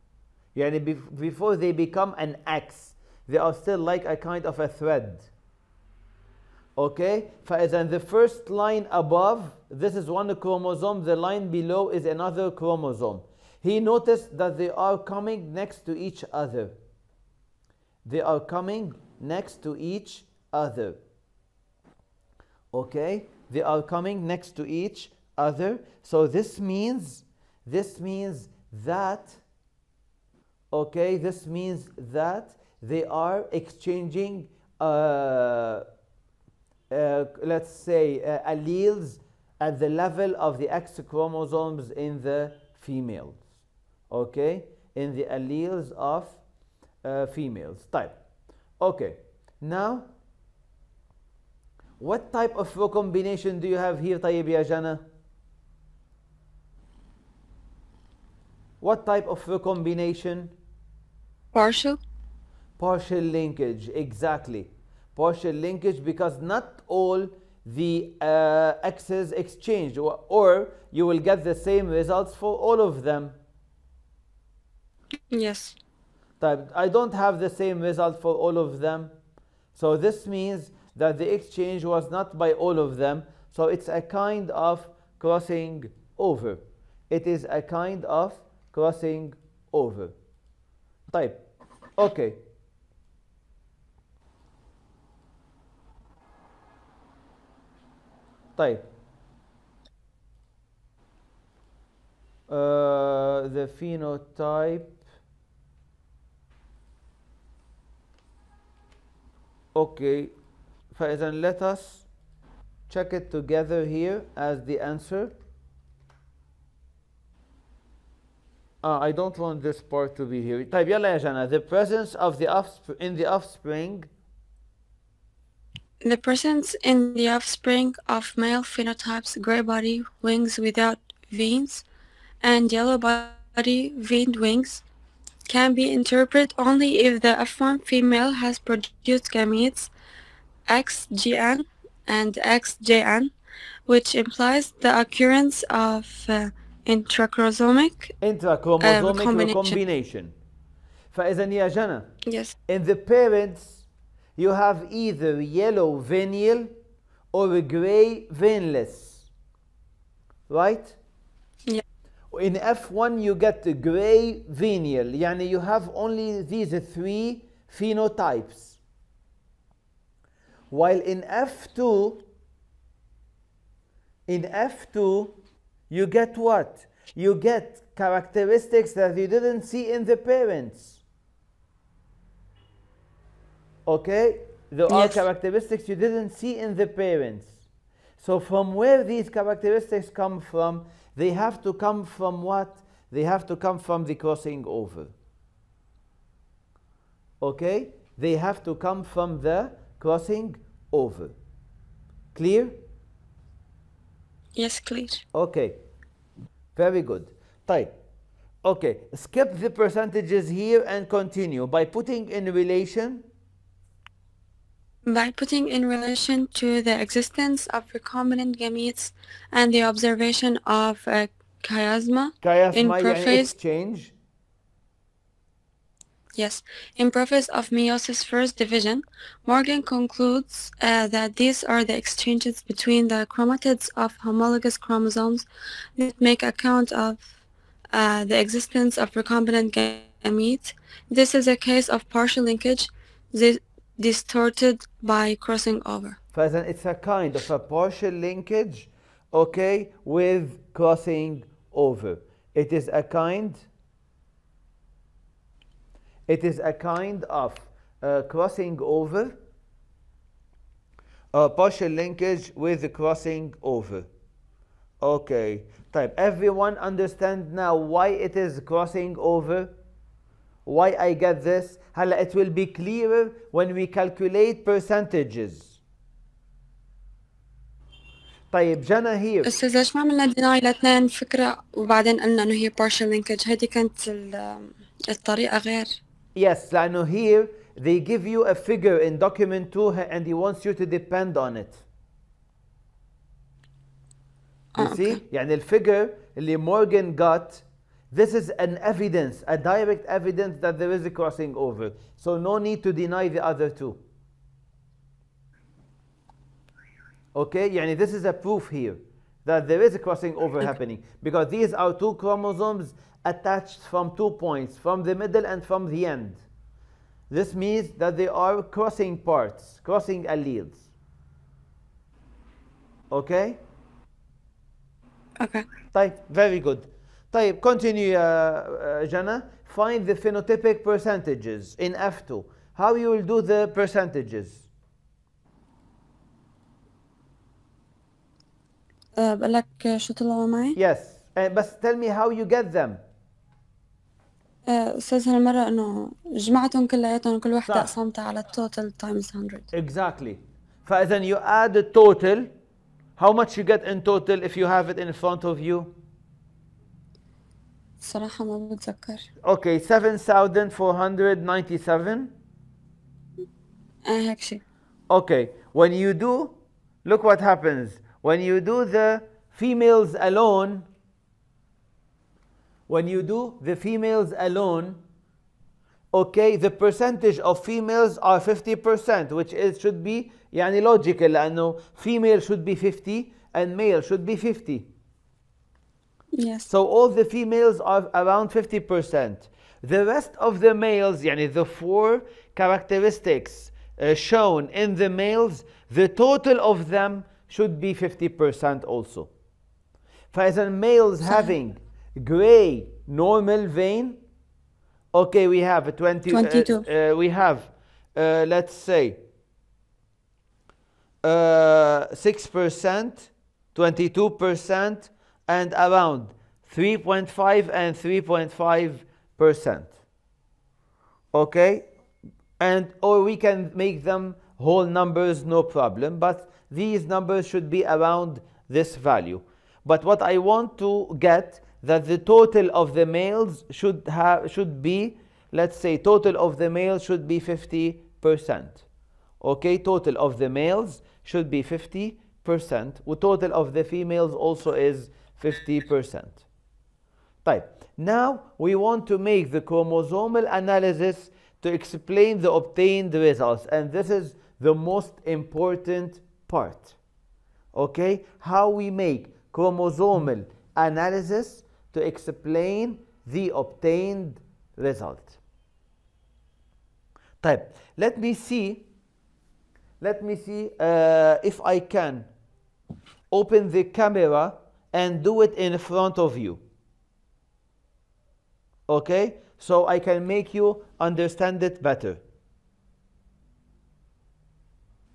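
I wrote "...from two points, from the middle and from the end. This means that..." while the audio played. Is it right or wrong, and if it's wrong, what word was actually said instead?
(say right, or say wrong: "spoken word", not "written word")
right.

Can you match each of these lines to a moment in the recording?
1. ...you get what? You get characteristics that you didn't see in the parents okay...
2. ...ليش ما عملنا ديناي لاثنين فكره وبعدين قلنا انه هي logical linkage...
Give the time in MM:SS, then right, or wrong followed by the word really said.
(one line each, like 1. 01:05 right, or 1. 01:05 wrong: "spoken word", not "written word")
1. 02:55 right
2. 04:39 wrong: "partial", not "logical".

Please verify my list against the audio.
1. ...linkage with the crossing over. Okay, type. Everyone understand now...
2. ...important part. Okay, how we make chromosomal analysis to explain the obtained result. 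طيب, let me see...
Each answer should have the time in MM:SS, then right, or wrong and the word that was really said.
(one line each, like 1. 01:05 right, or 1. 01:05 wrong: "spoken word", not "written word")
1. 04:21 right
2. 07:35 right.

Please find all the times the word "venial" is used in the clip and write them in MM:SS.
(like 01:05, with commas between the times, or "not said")
02:35, 02:44.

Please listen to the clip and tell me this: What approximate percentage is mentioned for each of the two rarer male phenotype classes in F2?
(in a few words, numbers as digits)
3.5%.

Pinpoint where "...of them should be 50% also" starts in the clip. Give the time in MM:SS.
06:36.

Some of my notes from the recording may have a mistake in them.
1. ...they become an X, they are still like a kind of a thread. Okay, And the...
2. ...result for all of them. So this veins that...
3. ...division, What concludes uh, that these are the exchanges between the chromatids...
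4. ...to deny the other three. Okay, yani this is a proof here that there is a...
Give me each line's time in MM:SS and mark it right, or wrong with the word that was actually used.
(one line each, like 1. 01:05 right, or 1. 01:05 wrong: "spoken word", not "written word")
1. 00:01 right
2. 01:17 wrong: "means", not "veins"
3. 03:48 wrong: "Morgan", not "What"
4. 05:02 wrong: "two", not "three".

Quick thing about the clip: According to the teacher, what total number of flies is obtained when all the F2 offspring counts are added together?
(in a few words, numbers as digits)
7497.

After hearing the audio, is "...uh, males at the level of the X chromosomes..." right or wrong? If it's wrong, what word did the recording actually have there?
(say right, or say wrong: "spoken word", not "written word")
wrong: "alleles", not "males".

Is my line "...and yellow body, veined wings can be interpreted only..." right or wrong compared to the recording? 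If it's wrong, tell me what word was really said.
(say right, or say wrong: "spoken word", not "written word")
right.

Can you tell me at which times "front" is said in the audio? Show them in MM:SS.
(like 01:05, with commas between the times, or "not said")
05:55, 07:55.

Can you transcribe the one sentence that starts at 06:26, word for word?
So all the females are around 50%.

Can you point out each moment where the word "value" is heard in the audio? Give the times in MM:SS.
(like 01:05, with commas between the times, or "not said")
07:08.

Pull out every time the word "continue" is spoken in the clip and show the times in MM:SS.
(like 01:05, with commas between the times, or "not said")
03:31, 05:27.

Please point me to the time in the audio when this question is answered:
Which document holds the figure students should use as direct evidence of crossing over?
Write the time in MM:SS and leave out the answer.
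04:49.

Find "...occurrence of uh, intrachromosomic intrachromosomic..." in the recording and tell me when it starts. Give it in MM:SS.
02:24.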